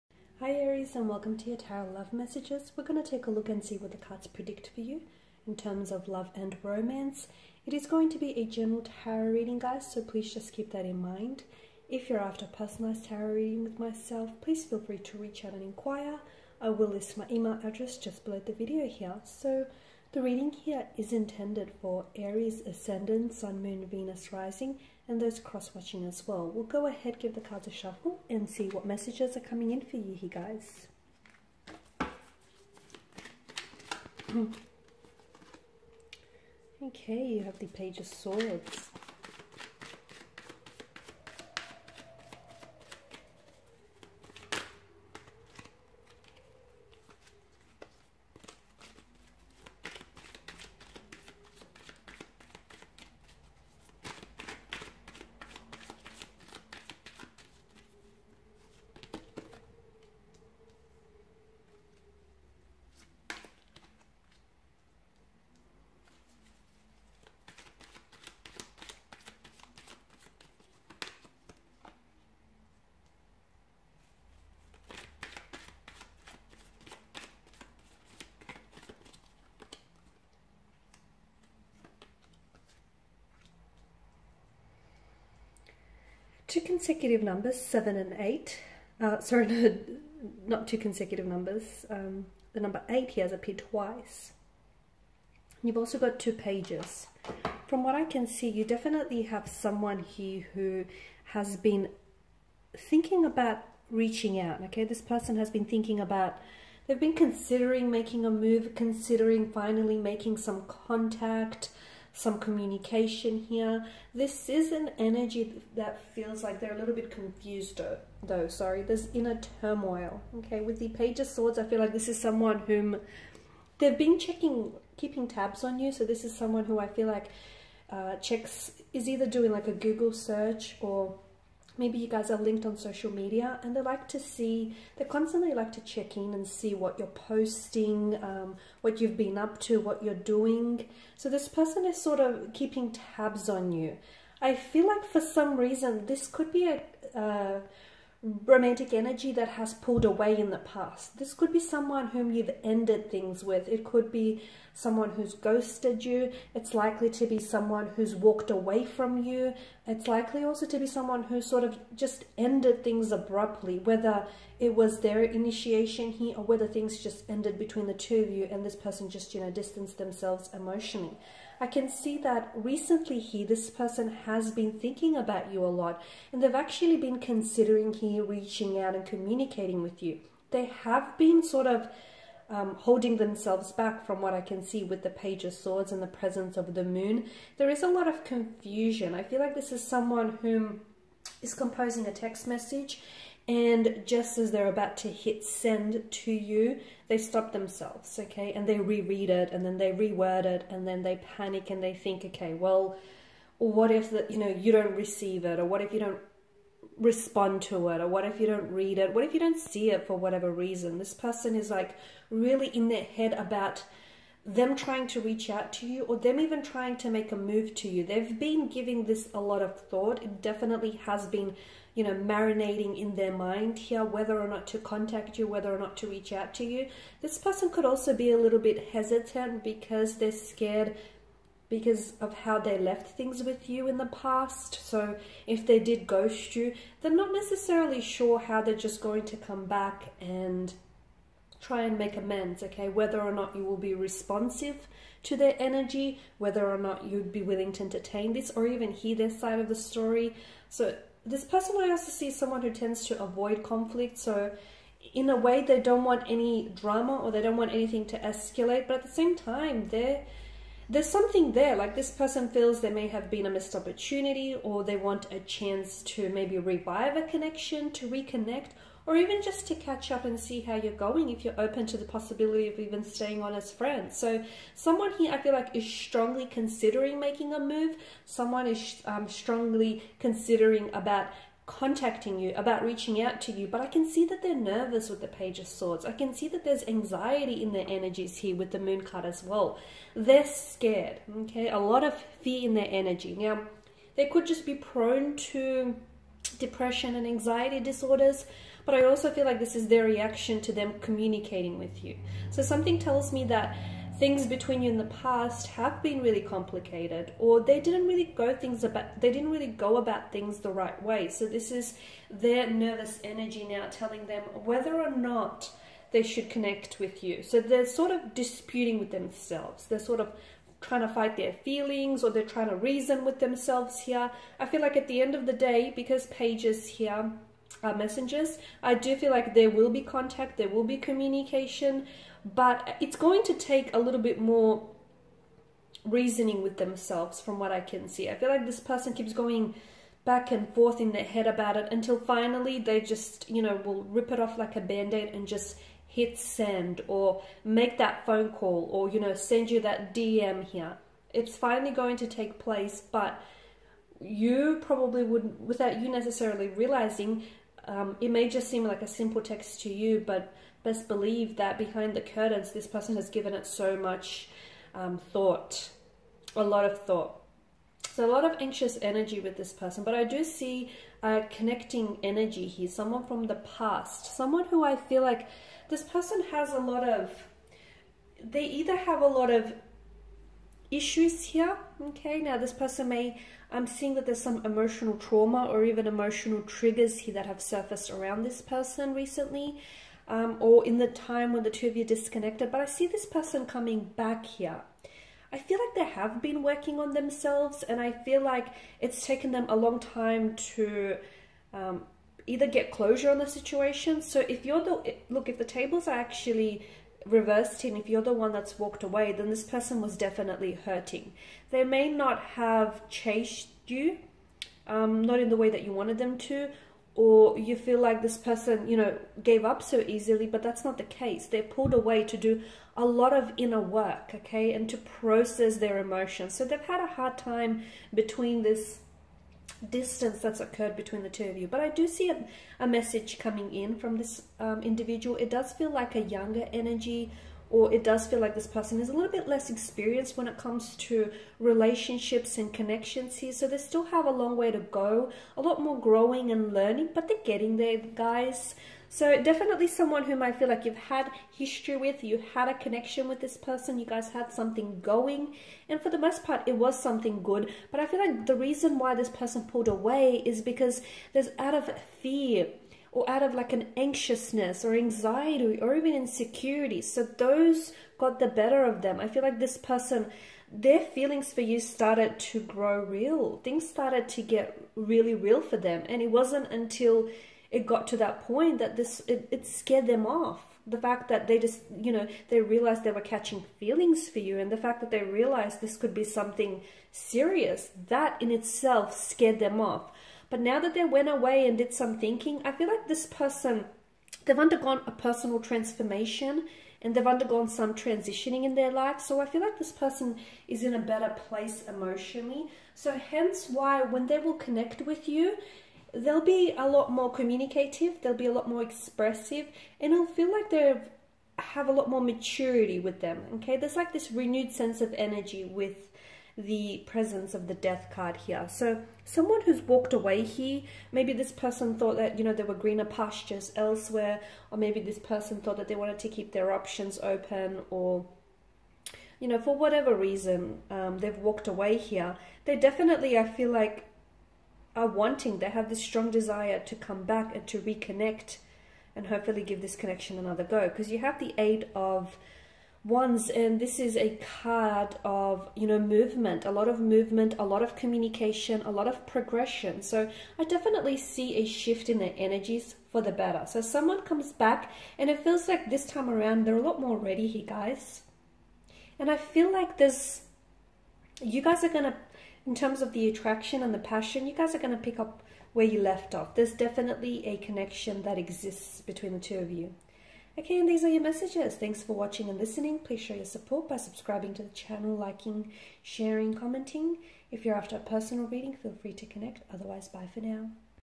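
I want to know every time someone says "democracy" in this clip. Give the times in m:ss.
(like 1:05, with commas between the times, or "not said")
not said.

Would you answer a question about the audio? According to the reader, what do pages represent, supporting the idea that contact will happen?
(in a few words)
Messengers.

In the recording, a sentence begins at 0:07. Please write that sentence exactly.
It is going to be a general tarot reading guys, so please just keep that in mind.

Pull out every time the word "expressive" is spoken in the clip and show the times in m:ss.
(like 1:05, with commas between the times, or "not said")
8:28.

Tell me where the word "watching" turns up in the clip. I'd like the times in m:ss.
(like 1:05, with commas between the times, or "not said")
0:25, 9:32.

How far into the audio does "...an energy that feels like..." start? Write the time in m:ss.
1:54.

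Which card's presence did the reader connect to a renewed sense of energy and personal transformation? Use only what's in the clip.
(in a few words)
Death.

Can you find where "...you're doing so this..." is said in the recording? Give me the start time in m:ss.
2:20.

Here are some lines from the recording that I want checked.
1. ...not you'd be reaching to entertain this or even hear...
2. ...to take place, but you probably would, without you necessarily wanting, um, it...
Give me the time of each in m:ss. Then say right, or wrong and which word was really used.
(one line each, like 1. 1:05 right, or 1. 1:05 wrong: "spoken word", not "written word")
1. 4:06 wrong: "willing", not "reaching"
2. 5:52 wrong: "realizing", not "wanting".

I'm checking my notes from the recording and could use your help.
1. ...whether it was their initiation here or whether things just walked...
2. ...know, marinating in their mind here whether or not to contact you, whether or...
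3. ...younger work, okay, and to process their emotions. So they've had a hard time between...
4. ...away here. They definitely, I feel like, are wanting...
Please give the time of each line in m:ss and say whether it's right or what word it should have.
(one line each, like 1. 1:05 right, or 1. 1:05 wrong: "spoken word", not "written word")
1. 2:43 wrong: "ended", not "walked"
2. 3:42 right
3. 7:03 wrong: "inner", not "younger"
4. 8:51 right.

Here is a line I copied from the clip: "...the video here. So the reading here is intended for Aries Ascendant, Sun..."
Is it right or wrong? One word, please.
right.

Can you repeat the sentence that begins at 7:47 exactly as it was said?
So those got the better of them.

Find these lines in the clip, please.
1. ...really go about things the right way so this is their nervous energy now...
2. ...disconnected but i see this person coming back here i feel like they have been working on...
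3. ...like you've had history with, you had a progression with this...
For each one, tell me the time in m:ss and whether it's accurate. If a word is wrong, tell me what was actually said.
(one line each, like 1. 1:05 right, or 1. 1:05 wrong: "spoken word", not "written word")
1. 5:09 right
2. 6:32 right
3. 7:30 wrong: "connection", not "progression".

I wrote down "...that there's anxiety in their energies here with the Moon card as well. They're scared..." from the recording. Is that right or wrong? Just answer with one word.
right.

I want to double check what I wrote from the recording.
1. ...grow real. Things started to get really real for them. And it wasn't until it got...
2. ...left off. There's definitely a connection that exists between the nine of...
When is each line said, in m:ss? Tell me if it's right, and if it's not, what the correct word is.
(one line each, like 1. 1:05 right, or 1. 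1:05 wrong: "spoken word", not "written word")
1. 7:52 right
2. 9:25 wrong: "two", not "nine".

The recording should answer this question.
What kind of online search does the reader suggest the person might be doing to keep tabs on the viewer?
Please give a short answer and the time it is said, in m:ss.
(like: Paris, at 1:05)
Google search, at 2:09.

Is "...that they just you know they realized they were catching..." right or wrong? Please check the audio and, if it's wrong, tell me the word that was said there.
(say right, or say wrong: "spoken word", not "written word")
right.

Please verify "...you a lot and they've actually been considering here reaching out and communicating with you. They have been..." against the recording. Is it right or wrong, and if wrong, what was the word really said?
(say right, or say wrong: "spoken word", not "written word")
right.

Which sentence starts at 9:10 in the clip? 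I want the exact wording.
So I definitely see a shift in their energies for the better.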